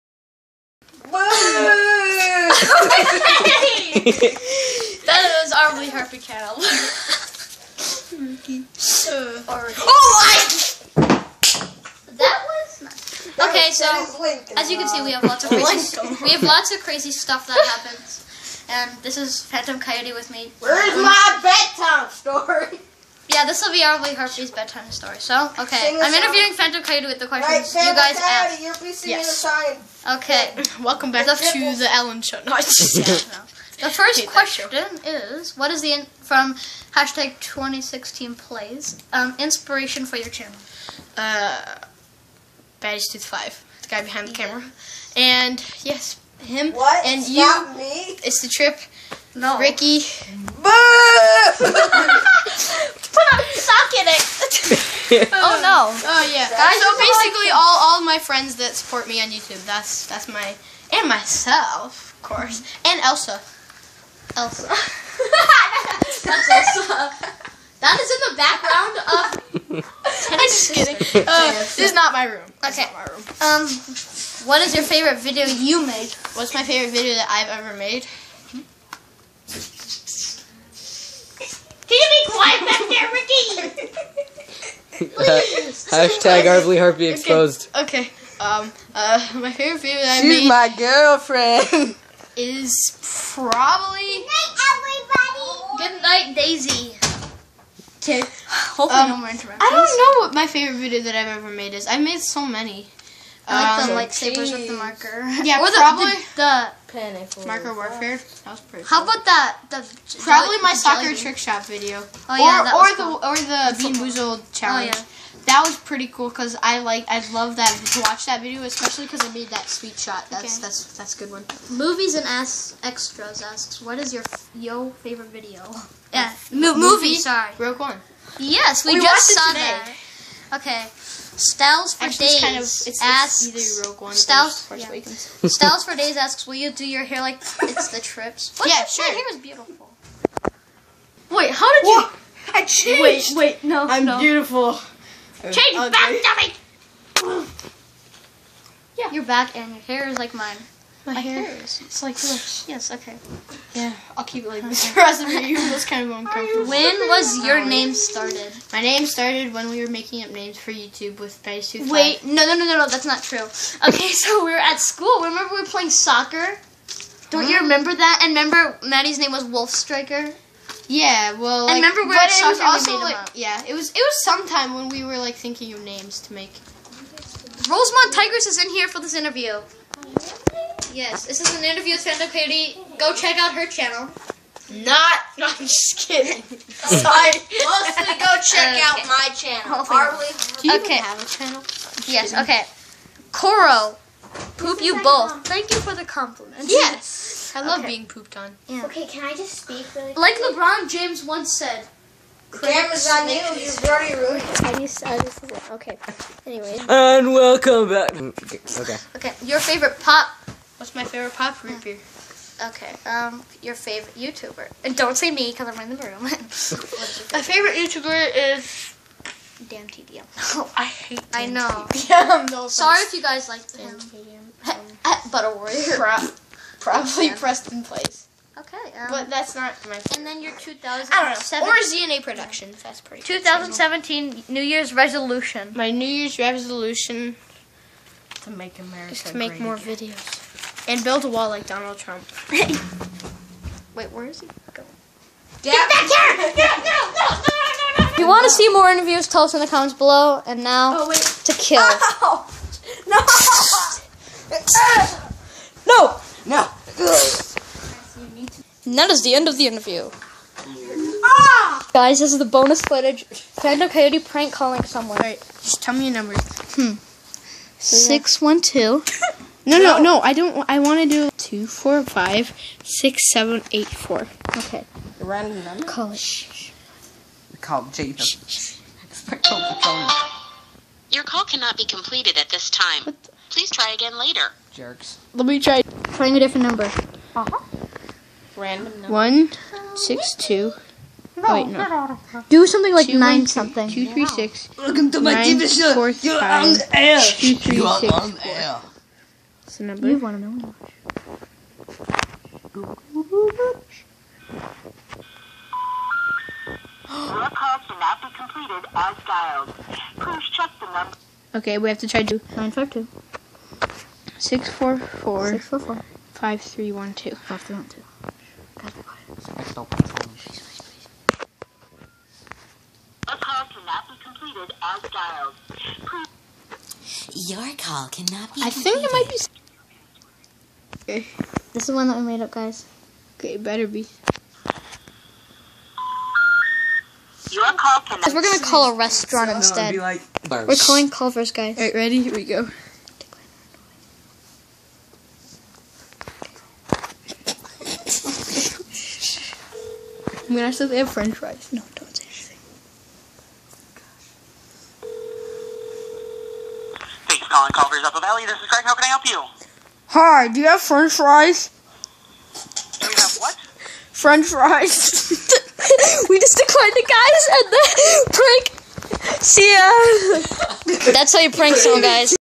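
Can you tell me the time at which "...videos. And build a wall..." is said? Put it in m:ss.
3:59.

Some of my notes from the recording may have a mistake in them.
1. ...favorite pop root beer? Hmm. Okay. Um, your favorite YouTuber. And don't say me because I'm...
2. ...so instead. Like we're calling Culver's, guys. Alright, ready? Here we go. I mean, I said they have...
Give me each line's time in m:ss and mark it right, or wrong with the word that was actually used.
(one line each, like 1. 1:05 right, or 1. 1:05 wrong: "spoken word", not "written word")
1. 3:31 right
2. 5:39 right.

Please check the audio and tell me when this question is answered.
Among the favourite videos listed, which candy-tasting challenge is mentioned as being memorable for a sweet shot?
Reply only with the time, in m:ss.
1:53.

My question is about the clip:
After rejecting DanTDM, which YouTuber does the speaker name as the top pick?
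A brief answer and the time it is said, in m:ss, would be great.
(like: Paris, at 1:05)
PrestonPlayz, at 3:47.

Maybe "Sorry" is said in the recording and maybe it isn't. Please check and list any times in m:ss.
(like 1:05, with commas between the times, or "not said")
2:07, 3:06, 3:42.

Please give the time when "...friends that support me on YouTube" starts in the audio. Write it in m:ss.
0:58.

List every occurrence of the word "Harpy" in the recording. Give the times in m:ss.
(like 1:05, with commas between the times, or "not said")
0:05, 0:24, 1:26.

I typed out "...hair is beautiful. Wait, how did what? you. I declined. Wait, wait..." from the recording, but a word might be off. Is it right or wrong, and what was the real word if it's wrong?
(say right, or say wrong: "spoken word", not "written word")
wrong: "changed", not "declined".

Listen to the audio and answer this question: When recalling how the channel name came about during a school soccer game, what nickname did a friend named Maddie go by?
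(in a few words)
Wolf Striker.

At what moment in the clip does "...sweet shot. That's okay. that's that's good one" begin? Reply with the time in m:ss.
1:59.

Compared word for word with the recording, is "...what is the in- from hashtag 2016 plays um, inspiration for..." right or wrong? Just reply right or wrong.
right.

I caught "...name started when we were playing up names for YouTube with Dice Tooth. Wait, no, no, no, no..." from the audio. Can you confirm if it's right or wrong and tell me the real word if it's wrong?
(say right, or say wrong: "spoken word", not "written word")
wrong: "making", not "playing".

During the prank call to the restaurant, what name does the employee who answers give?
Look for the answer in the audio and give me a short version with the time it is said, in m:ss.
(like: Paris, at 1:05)
Craig, at 5:58.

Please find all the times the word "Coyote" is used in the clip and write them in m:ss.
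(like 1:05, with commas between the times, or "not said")
0:19, 0:26, 4:23.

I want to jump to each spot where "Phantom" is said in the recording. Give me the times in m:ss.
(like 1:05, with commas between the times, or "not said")
0:19, 0:26, 4:23.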